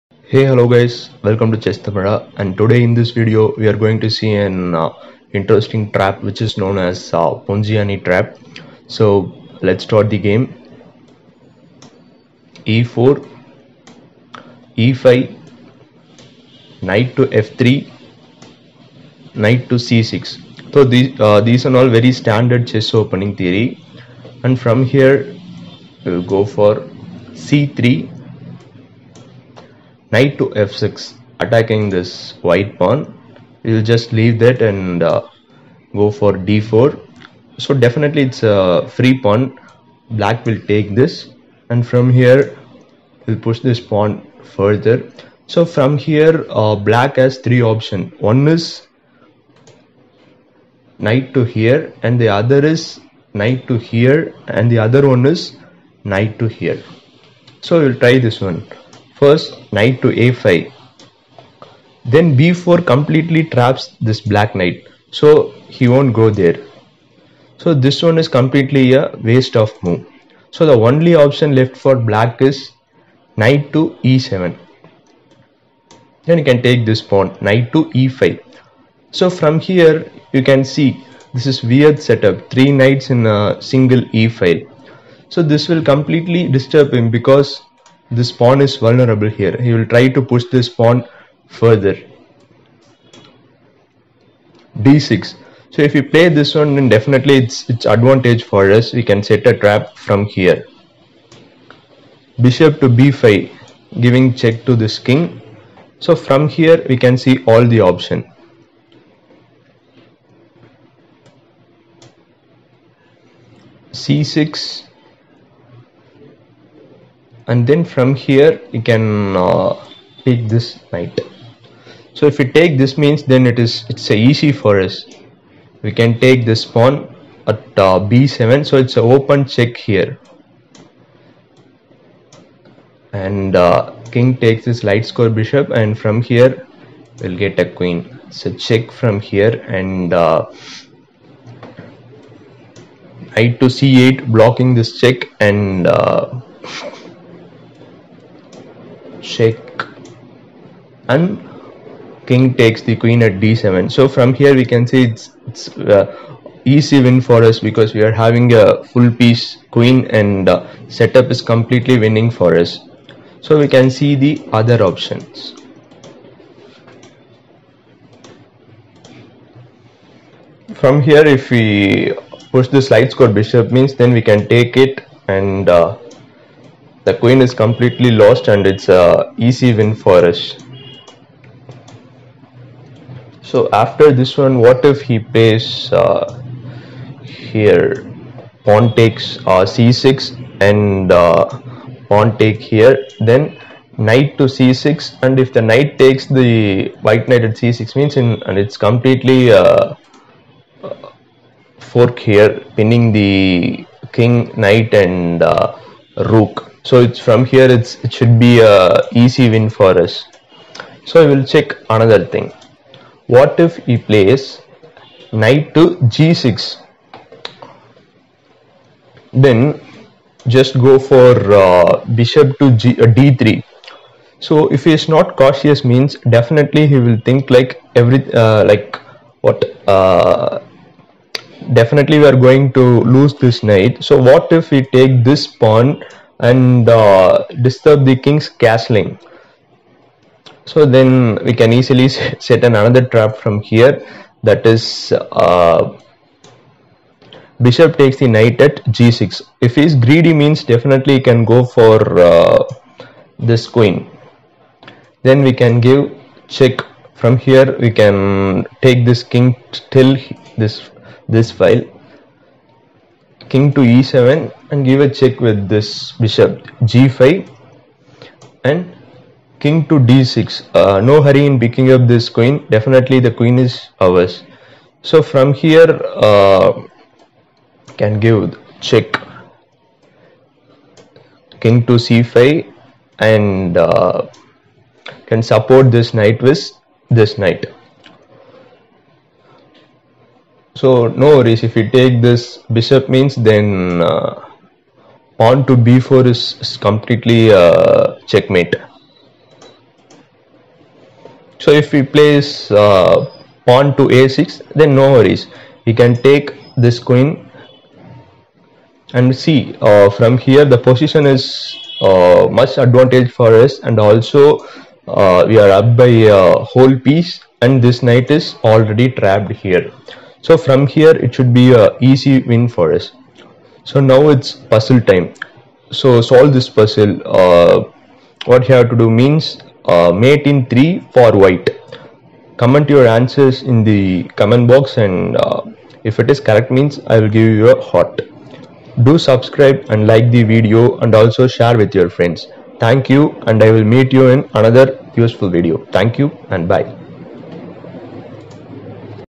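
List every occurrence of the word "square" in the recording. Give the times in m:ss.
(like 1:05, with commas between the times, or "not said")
2:15, 2:53.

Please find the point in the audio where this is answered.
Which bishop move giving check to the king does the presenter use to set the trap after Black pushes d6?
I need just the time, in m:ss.
1:42.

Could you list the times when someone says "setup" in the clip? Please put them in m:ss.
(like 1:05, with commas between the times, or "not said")
1:22, 2:40.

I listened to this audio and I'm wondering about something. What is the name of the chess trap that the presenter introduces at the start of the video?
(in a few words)
Ponziani trap.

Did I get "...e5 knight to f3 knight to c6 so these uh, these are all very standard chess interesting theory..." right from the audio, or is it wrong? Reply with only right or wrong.
wrong.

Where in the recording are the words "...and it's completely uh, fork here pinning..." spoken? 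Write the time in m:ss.
3:18.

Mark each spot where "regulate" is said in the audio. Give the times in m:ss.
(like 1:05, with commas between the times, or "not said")
not said.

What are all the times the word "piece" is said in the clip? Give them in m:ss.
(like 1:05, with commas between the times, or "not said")
2:39, 5:16.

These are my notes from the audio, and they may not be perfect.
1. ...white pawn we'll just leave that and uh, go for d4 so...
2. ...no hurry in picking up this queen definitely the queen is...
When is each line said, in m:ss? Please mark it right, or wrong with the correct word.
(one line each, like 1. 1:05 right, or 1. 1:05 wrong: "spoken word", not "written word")
1. 0:32 right
2. 4:31 right.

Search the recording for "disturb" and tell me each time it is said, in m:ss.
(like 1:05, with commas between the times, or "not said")
1:26, 3:57.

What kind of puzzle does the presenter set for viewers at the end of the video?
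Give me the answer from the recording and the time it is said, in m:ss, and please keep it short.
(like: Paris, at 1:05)
Mate in 3, at 5:30.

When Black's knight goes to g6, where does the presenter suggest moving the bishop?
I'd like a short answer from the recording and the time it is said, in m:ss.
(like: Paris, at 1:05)
d3, at 3:43.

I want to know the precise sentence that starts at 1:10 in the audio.
So the only option left for black is knight to e7.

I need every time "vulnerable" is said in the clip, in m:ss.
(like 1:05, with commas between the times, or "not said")
1:28.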